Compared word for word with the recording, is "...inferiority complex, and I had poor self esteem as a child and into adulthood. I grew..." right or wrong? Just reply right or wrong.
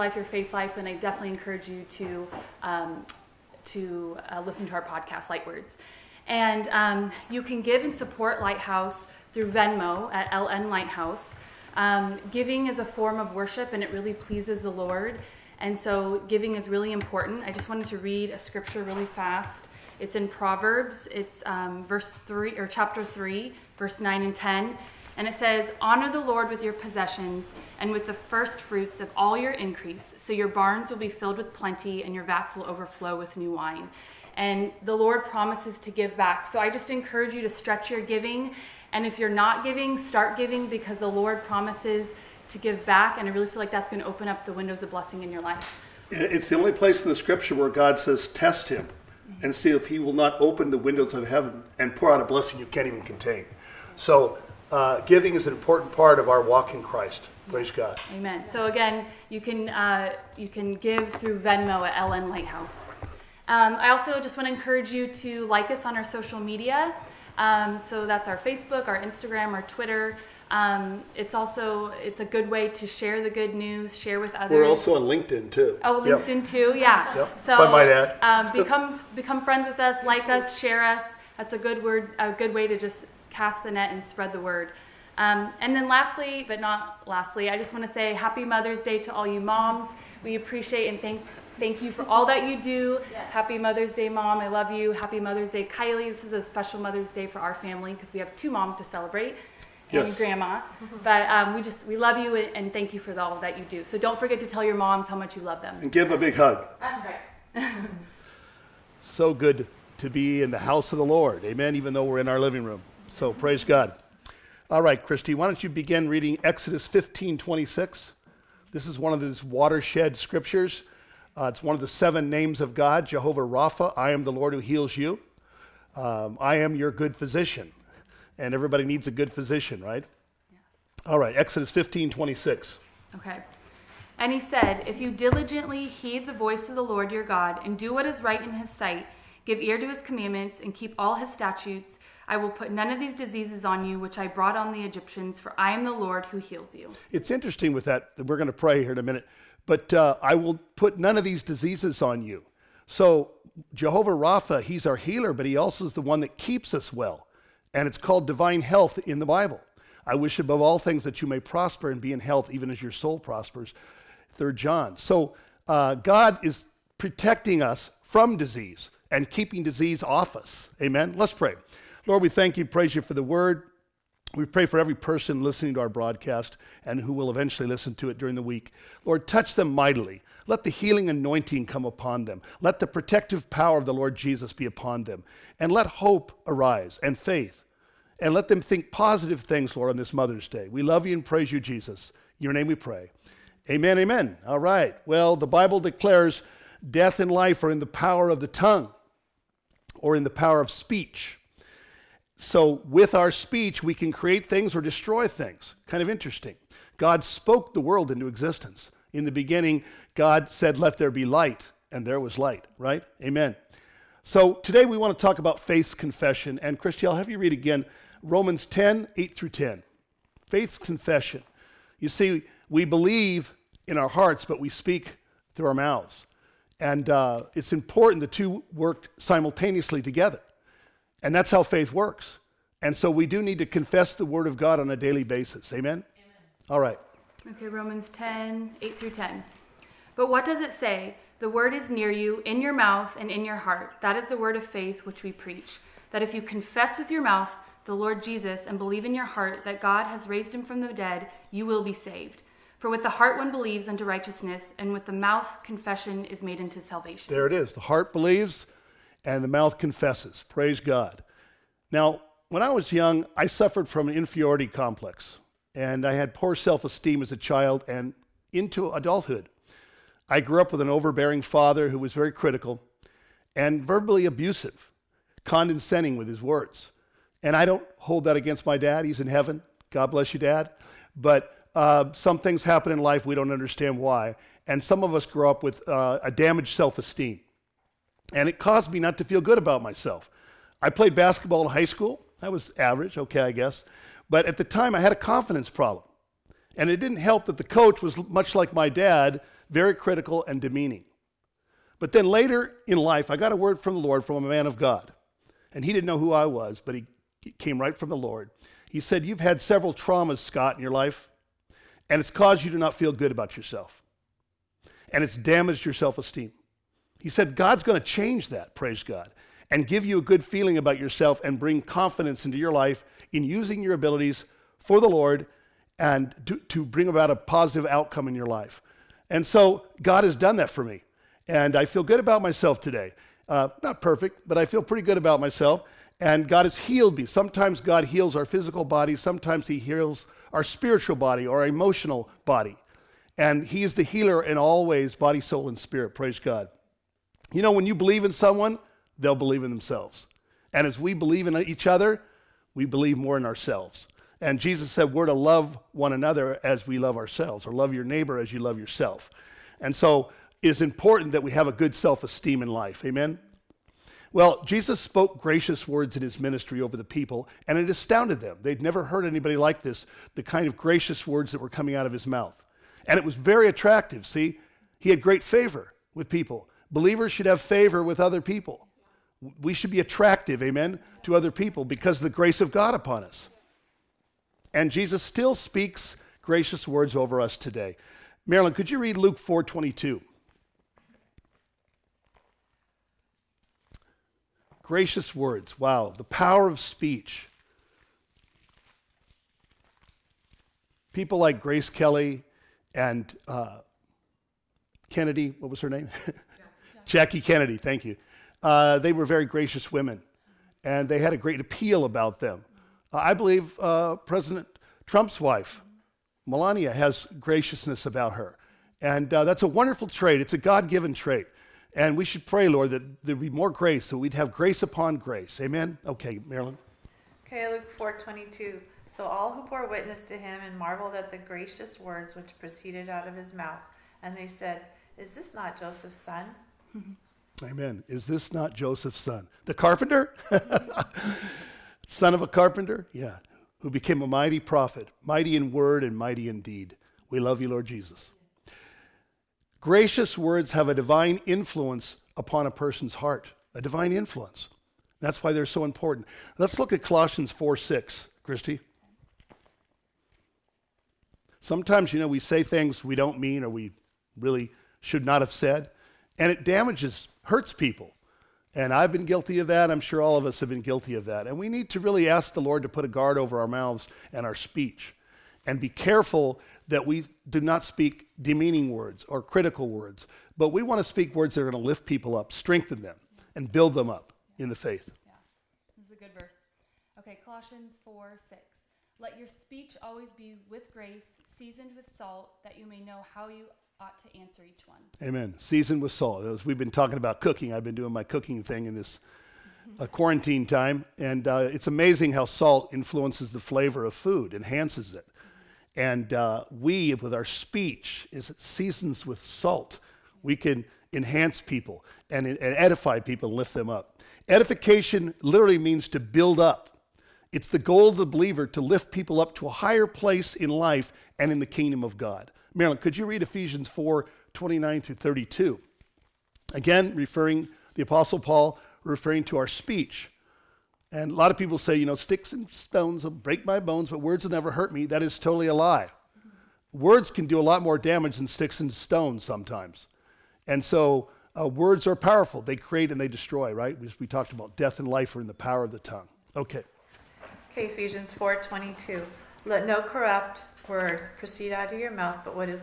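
right.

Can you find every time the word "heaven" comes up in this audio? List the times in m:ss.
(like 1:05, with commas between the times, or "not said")
0:51, 4:39.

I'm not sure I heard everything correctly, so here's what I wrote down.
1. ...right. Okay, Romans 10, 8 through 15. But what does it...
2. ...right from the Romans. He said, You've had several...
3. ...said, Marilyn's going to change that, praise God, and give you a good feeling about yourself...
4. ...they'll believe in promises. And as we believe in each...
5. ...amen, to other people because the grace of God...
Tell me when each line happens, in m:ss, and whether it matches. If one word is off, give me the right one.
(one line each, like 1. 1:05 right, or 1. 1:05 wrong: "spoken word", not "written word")
1. 3:56 wrong: "10", not "15"
2. 5:07 wrong: "Lord", not "Romans"
3. 5:17 wrong: "God", not "Marilyn"
4. 5:49 wrong: "themselves", not "promises"
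5. 6:20 right.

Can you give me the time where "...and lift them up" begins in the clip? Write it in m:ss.
8:33.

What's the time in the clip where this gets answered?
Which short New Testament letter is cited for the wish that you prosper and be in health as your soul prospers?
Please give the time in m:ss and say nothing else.
2:44.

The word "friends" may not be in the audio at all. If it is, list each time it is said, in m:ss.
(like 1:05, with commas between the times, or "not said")
1:19.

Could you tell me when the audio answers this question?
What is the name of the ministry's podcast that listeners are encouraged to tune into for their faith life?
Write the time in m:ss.
0:05.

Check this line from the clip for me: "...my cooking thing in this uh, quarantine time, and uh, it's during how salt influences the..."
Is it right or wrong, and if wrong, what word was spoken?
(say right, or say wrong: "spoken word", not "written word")
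wrong: "amazing", not "during".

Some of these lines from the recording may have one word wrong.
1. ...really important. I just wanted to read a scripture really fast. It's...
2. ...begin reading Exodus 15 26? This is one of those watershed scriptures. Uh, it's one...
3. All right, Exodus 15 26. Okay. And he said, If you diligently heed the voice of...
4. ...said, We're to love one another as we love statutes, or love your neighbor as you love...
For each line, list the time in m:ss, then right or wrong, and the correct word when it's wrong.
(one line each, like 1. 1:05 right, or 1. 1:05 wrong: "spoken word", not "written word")
1. 0:16 right
2. 1:55 right
3. 2:11 right
4. 5:54 wrong: "ourselves", not "statutes".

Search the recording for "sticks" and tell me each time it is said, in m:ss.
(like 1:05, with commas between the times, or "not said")
8:52, 8:58.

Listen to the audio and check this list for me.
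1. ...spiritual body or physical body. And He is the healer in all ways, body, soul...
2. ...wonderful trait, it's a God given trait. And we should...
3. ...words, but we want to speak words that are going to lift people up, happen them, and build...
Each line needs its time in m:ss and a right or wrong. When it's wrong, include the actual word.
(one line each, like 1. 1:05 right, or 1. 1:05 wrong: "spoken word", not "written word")
1. 5:40 wrong: "emotional", not "physical"
2. 6:59 right
3. 7:59 wrong: "strengthen", not "happen".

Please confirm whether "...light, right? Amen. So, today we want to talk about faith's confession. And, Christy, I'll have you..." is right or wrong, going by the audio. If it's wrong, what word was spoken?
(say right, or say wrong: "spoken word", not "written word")
right.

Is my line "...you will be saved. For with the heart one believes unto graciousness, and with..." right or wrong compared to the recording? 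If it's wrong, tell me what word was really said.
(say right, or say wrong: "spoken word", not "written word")
wrong: "righteousness", not "graciousness".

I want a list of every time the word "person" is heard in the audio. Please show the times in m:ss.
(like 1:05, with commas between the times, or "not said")
2:54, 7:32.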